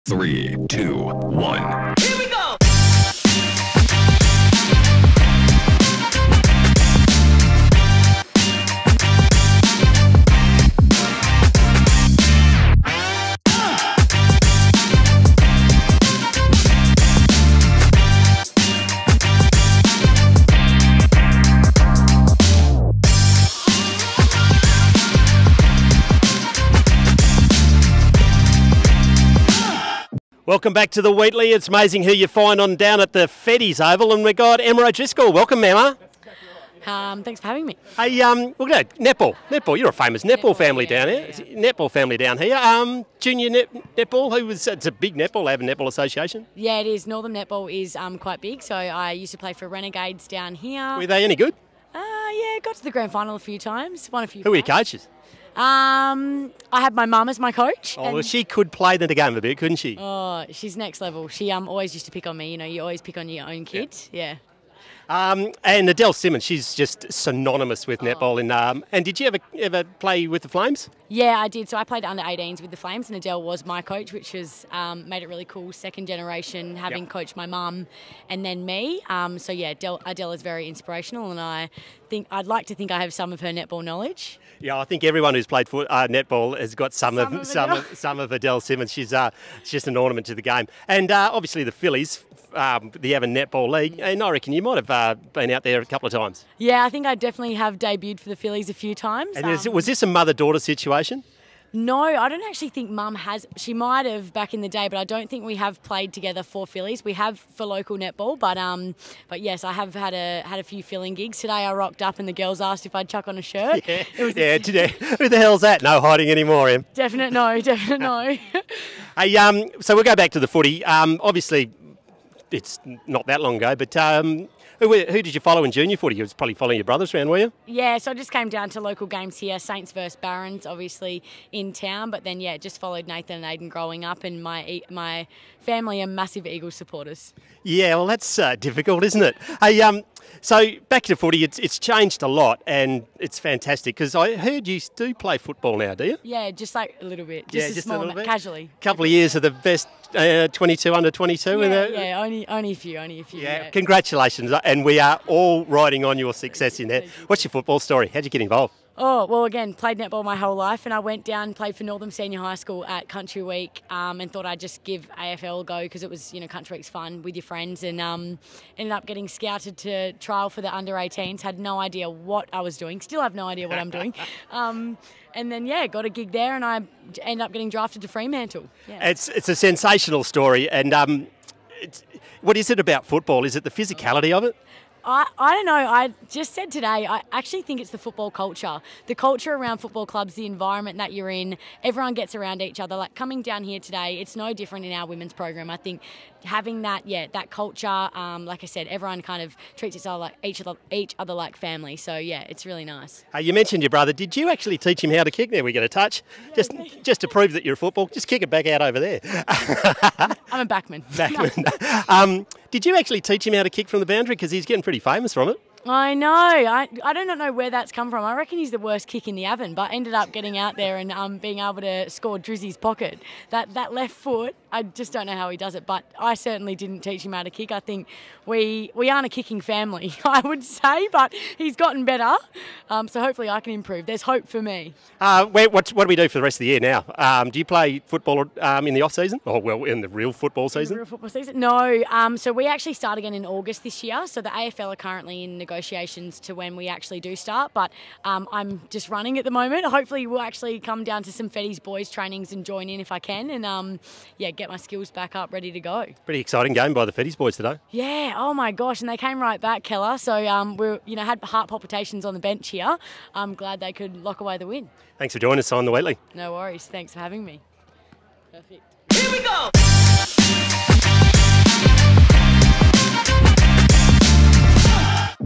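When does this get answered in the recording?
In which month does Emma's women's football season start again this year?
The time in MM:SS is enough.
04:03.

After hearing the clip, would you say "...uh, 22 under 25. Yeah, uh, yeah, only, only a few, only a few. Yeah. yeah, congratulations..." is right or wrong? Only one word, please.
wrong.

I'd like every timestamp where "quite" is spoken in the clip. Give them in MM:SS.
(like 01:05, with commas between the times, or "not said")
00:48.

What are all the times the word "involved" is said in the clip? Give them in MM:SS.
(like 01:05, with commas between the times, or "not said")
02:38.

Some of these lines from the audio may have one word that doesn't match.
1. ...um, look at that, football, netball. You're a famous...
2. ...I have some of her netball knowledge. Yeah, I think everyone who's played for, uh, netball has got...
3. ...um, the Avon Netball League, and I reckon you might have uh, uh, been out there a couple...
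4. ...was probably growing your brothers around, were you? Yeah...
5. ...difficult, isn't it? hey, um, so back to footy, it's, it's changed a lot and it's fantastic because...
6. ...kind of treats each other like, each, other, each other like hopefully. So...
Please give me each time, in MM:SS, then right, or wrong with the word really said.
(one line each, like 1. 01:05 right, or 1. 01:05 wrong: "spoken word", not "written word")
1. 00:38 wrong: "netball", not "football"
2. 01:22 right
3. 01:32 right
4. 02:06 wrong: "following", not "growing"
5. 02:18 right
6. 03:19 wrong: "family", not "hopefully".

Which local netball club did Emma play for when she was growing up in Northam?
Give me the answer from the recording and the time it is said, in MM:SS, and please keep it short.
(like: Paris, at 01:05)
Renegades, at 00:49.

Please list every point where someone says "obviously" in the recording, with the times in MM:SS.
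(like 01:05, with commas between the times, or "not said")
01:31, 02:01, 02:10.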